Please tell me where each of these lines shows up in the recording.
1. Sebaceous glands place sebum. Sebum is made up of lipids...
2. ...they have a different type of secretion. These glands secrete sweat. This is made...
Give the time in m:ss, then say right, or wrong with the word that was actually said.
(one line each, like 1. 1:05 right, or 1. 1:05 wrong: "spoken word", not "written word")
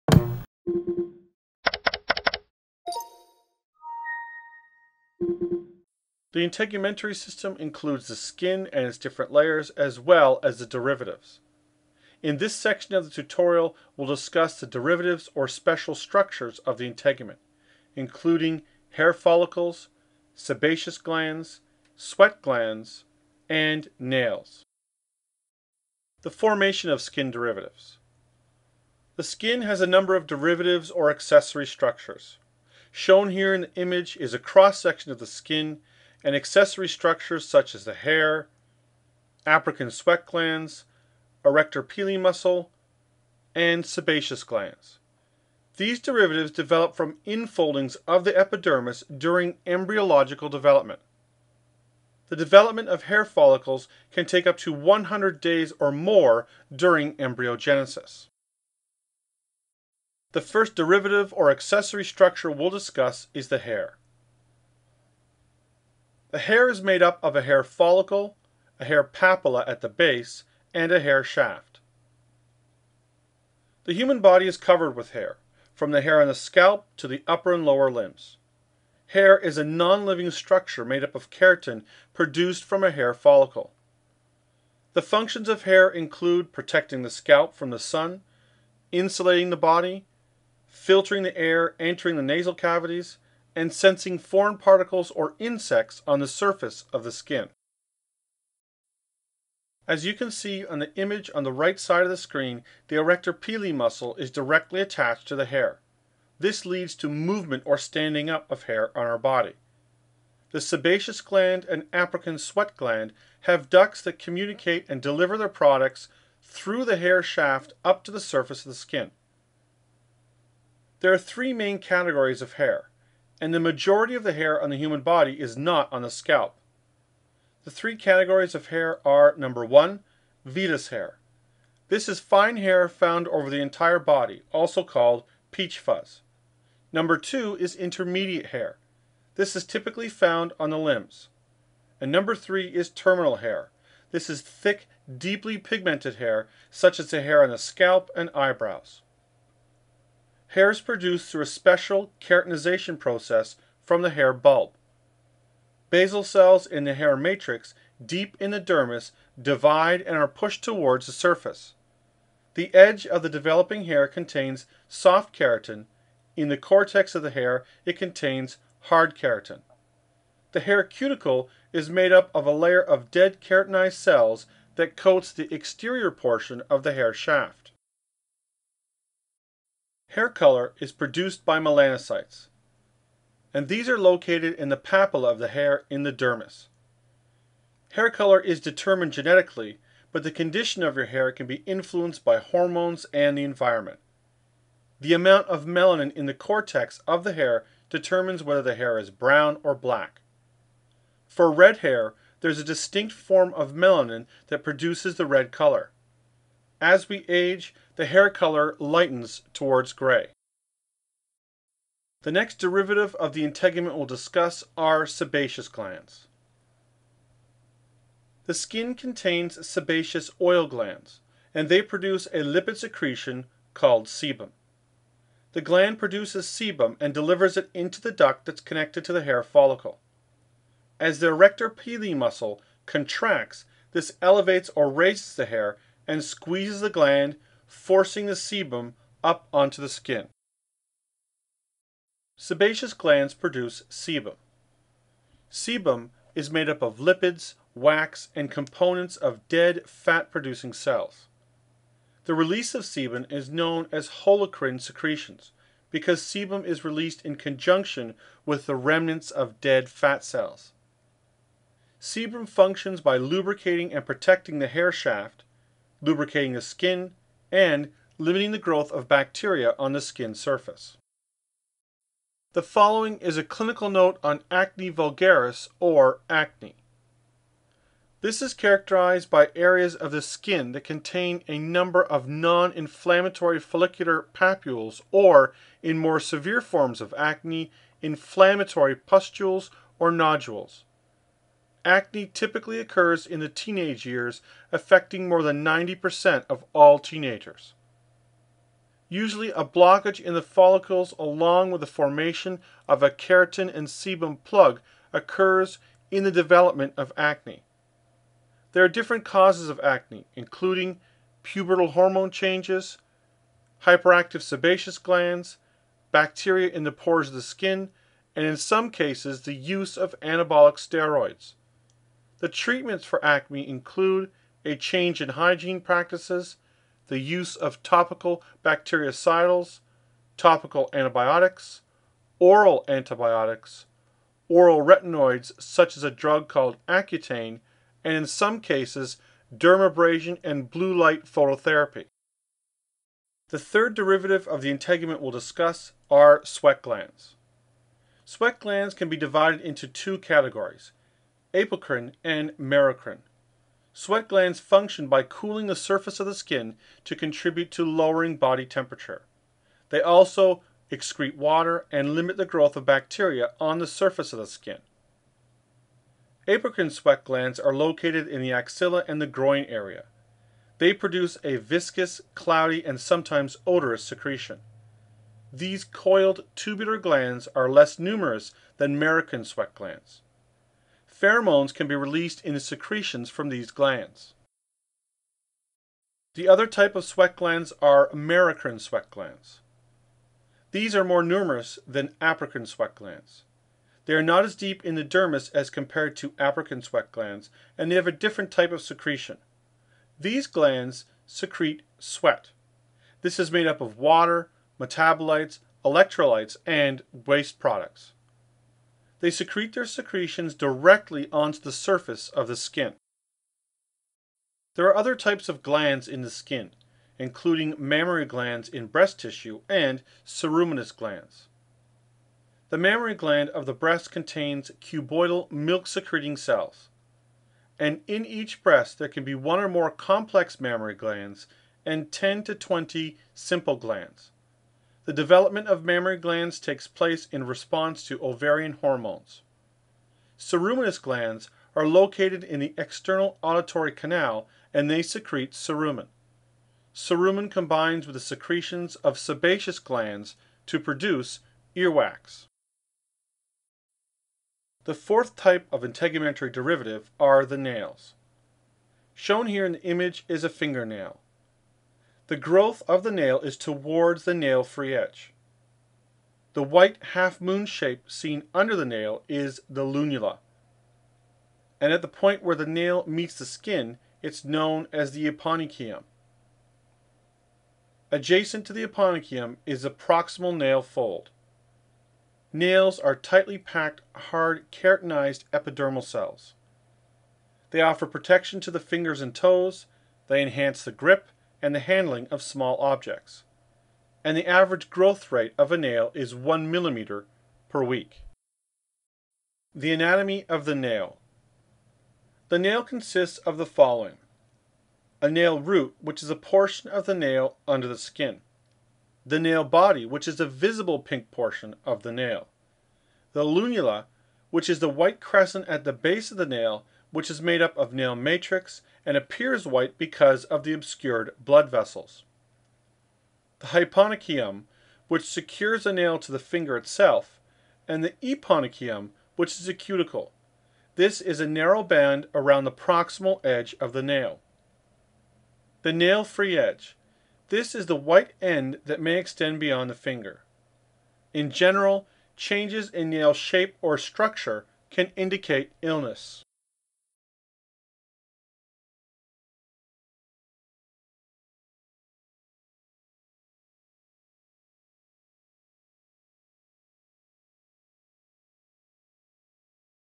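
1. 4:02 wrong: "produce", not "place"
2. 6:37 right.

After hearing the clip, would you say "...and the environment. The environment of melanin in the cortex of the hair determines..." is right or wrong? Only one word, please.
wrong.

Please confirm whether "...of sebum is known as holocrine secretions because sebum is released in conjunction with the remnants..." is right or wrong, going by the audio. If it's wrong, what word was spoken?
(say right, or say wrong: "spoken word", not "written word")
right.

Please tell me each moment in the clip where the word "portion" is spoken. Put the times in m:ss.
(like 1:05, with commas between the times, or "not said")
2:56, 8:26, 8:31.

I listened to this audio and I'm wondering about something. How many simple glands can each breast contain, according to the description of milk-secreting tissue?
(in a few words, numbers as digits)
10 to 20.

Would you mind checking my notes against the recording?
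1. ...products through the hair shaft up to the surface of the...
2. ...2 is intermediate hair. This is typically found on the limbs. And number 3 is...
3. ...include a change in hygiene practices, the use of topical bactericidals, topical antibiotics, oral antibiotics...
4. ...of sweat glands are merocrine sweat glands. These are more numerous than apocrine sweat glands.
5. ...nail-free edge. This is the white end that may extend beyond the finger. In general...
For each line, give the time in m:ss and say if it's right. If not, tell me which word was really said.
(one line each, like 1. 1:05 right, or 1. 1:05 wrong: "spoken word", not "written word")
1. 1:55 right
2. 2:17 right
3. 5:23 right
4. 6:26 right
5. 8:55 right.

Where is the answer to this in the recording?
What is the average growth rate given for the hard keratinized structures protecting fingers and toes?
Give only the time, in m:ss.
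8:16.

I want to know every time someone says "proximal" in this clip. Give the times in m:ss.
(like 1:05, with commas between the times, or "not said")
7:59, 8:52.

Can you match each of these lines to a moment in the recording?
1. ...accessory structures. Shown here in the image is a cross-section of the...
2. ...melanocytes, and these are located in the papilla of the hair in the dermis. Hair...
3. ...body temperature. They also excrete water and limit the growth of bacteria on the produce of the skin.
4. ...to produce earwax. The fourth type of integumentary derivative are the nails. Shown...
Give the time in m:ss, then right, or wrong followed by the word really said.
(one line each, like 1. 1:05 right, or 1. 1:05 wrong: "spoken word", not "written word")
1. 0:31 right
2. 3:01 right
3. 5:58 wrong: "surface", not "produce"
4. 7:30 right.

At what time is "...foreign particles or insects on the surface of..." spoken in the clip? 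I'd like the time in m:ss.
1:34.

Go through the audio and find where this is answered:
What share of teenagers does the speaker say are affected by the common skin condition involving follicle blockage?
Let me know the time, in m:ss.
4:55.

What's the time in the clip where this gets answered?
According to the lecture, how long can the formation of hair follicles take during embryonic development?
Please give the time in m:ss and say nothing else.
0:54.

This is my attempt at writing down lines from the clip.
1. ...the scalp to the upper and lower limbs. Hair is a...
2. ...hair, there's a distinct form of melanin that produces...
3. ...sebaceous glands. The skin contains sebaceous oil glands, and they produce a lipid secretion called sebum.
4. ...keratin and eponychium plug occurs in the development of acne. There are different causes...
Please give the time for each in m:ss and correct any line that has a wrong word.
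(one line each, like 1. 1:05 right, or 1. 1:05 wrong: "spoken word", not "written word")
1. 1:16 right
2. 3:21 right
3. 3:35 right
4. 5:03 wrong: "sebum", not "eponychium".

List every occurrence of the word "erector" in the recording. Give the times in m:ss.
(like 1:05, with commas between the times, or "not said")
0:41, 1:42, 3:51.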